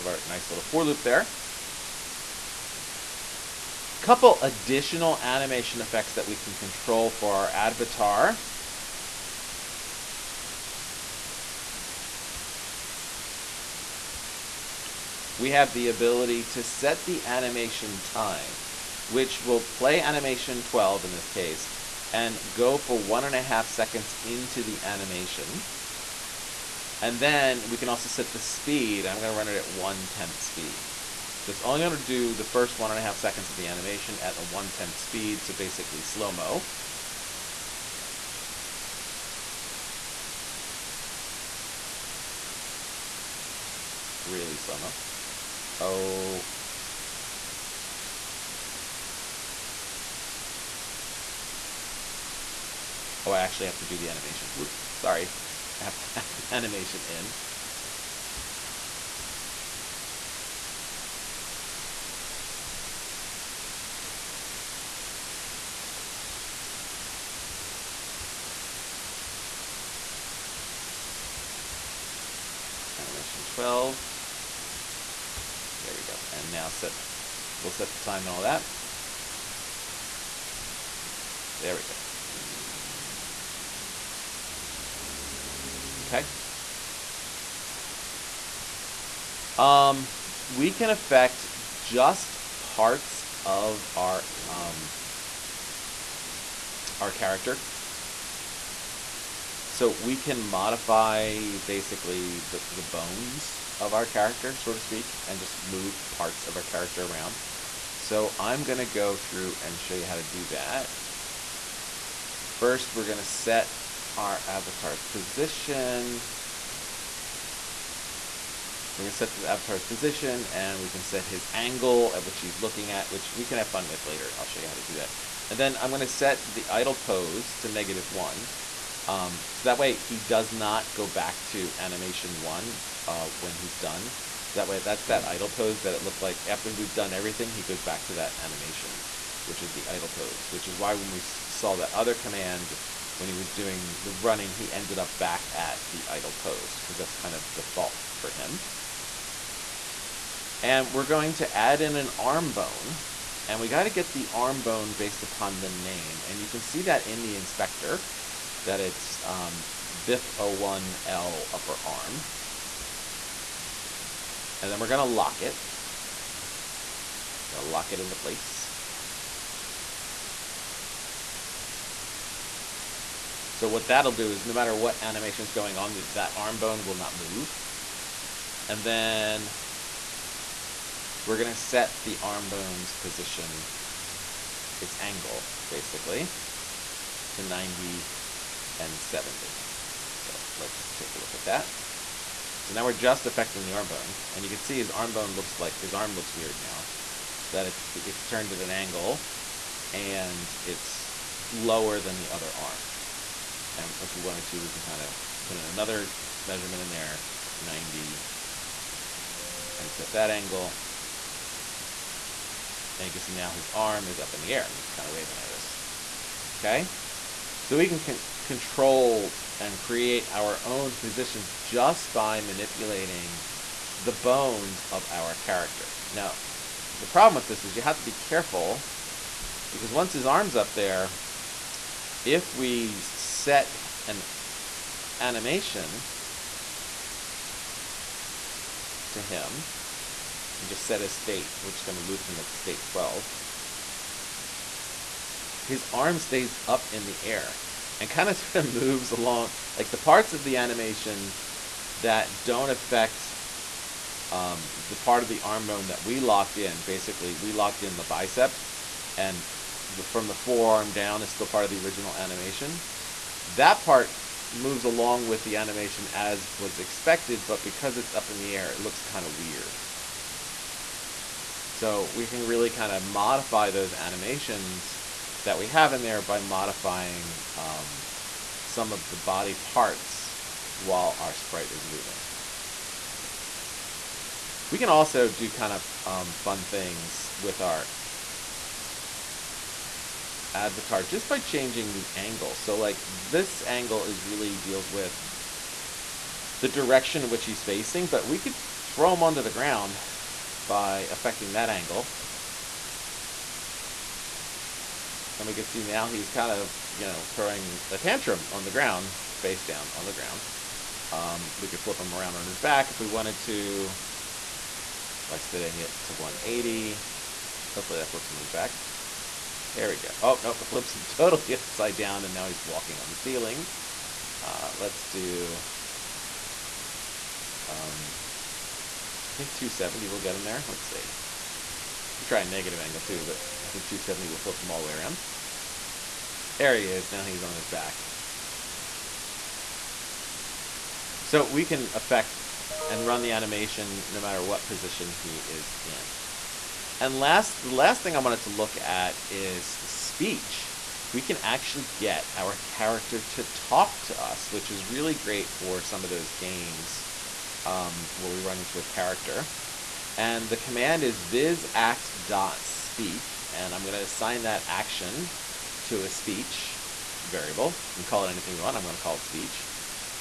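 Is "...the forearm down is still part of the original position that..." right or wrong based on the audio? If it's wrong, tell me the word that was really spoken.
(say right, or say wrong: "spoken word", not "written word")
wrong: "animation", not "position".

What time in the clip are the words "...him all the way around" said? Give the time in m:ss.
5:34.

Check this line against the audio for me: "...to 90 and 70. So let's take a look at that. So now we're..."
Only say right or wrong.
right.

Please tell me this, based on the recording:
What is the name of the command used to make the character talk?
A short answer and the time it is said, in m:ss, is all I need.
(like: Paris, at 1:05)
vizact.speak, at 6:01.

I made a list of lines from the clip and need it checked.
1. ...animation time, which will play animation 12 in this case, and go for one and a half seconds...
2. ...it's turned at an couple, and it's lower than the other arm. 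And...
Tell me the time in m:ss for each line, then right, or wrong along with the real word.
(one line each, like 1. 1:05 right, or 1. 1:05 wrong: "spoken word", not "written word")
1. 0:17 right
2. 3:17 wrong: "angle", not "couple".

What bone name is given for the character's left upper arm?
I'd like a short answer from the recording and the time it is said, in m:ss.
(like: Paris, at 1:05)
BIP01L upper arm, at 2:40.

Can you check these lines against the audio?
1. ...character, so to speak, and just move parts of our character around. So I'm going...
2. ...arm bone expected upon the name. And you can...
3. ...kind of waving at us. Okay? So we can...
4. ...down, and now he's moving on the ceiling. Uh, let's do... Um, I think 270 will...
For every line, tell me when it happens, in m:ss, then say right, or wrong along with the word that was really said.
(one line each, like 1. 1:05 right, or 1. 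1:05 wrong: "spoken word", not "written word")
1. 1:44 right
2. 2:34 wrong: "based", not "expected"
3. 3:34 right
4. 5:21 wrong: "walking", not "moving".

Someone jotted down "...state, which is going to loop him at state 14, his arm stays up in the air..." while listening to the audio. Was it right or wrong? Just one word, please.
wrong.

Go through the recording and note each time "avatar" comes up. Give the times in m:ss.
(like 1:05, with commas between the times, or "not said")
0:07, 1:54, 1:59, 4:50.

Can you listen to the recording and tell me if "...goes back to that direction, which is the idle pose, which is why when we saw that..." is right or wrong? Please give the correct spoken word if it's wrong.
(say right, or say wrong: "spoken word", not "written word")
wrong: "animation", not "direction".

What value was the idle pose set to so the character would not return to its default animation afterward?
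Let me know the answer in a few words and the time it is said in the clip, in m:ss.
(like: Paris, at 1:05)
-1, at 2:07.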